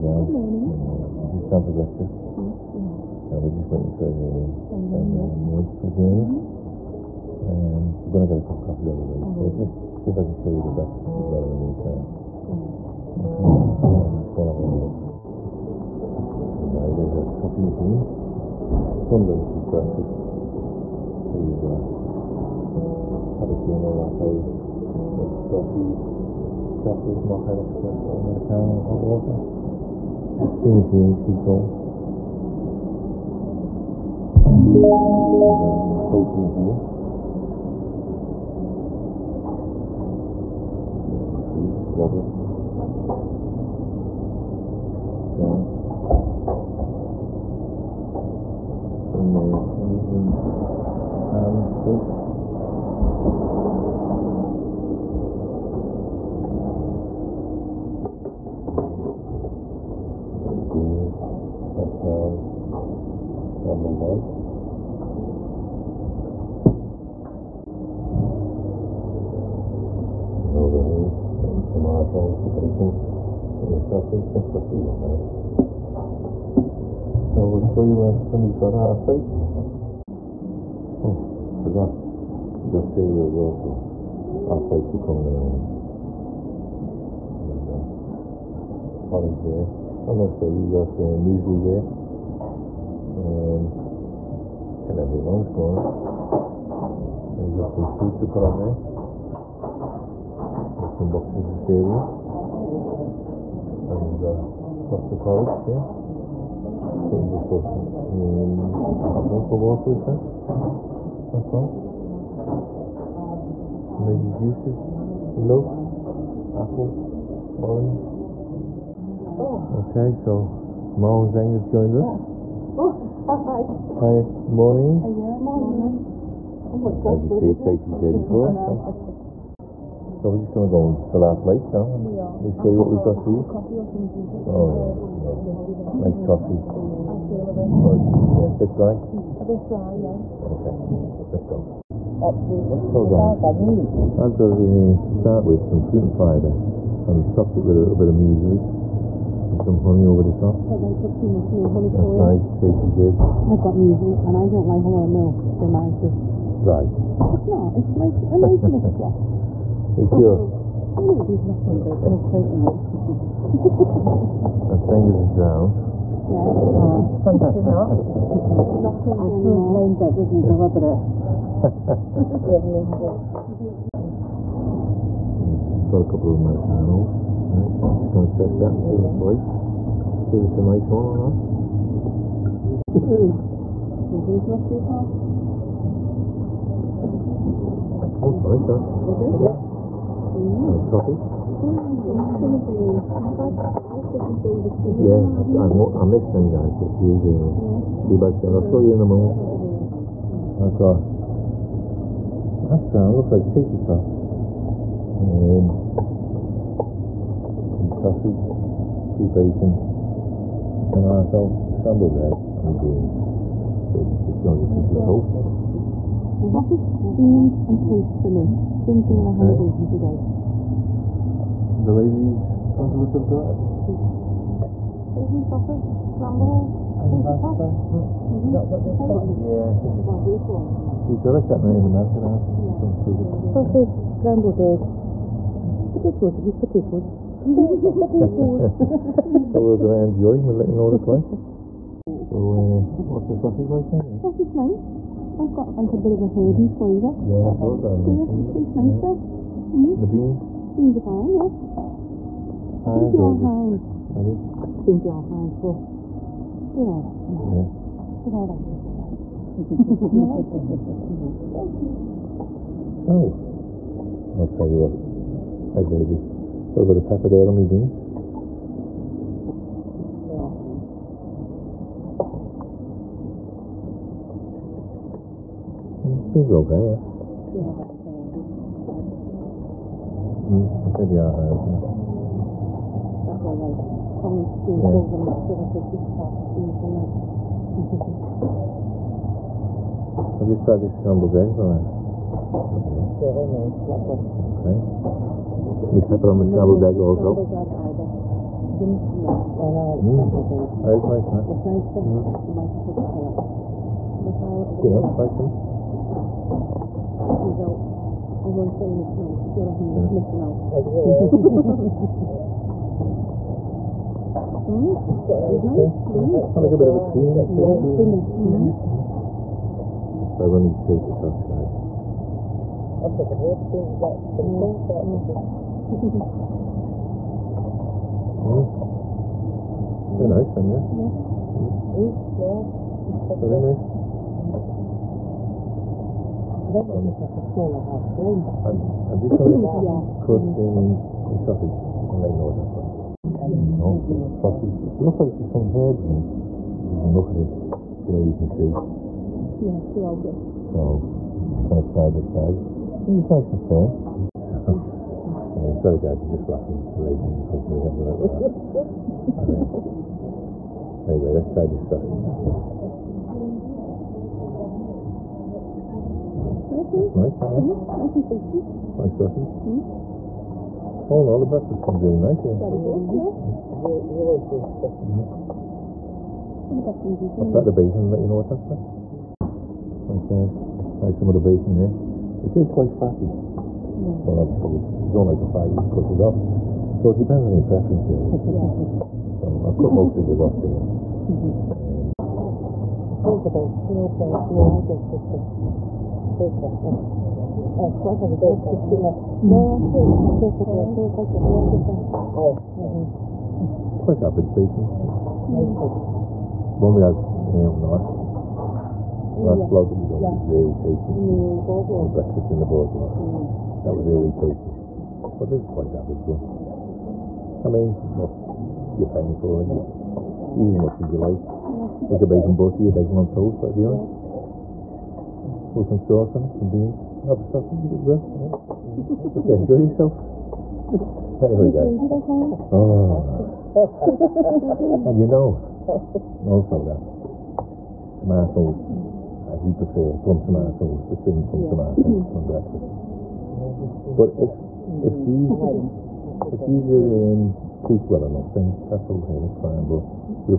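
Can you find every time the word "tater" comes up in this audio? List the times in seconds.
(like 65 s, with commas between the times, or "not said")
203 s, 227 s, 320 s.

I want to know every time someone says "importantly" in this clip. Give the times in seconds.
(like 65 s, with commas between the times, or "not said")
not said.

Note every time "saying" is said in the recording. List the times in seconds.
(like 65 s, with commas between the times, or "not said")
308 s.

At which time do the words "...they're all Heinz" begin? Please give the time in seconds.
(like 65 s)
253 s.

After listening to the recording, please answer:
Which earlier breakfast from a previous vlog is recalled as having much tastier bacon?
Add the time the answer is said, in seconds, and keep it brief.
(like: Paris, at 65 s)
Breakfast in the Boardwalk, at 412 s.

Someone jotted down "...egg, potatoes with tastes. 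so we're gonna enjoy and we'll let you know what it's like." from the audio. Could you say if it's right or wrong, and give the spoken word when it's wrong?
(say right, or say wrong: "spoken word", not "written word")
wrong: "potatoes", not "tastes".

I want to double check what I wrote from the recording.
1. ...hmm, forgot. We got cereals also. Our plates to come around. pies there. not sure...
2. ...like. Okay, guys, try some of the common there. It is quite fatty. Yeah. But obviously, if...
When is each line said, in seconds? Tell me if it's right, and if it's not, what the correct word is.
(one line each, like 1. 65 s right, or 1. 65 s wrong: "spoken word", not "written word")
1. 81 s right
2. 378 s wrong: "bacon", not "common".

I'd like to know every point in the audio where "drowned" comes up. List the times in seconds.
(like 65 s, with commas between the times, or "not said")
165 s.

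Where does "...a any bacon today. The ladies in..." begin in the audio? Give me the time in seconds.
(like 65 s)
219 s.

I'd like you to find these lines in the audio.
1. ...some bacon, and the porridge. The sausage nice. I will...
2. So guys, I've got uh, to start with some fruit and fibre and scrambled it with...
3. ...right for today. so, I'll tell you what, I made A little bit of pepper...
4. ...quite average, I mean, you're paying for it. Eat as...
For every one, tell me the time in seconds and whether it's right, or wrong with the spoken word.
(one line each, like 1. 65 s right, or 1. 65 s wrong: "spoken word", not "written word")
1. 72 s wrong: "sausage", not "porridge"
2. 142 s wrong: "topped", not "scrambled"
3. 258 s right
4. 415 s right.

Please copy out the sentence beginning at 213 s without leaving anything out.
She's just done as a piece of toast.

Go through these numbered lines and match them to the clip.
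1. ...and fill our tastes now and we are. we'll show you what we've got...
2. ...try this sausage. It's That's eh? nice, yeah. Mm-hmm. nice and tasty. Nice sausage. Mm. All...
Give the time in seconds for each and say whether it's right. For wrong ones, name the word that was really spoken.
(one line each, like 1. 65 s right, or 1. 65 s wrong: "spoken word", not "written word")
1. 130 s wrong: "plates", not "tastes"
2. 361 s right.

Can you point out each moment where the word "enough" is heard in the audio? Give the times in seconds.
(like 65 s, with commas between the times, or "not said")
162 s, 448 s.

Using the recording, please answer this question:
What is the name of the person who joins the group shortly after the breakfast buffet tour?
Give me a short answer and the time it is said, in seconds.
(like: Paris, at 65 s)
Mao Zeng, at 120 s.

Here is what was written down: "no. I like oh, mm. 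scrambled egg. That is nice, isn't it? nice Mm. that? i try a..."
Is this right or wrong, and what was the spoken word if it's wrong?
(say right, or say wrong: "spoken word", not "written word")
right.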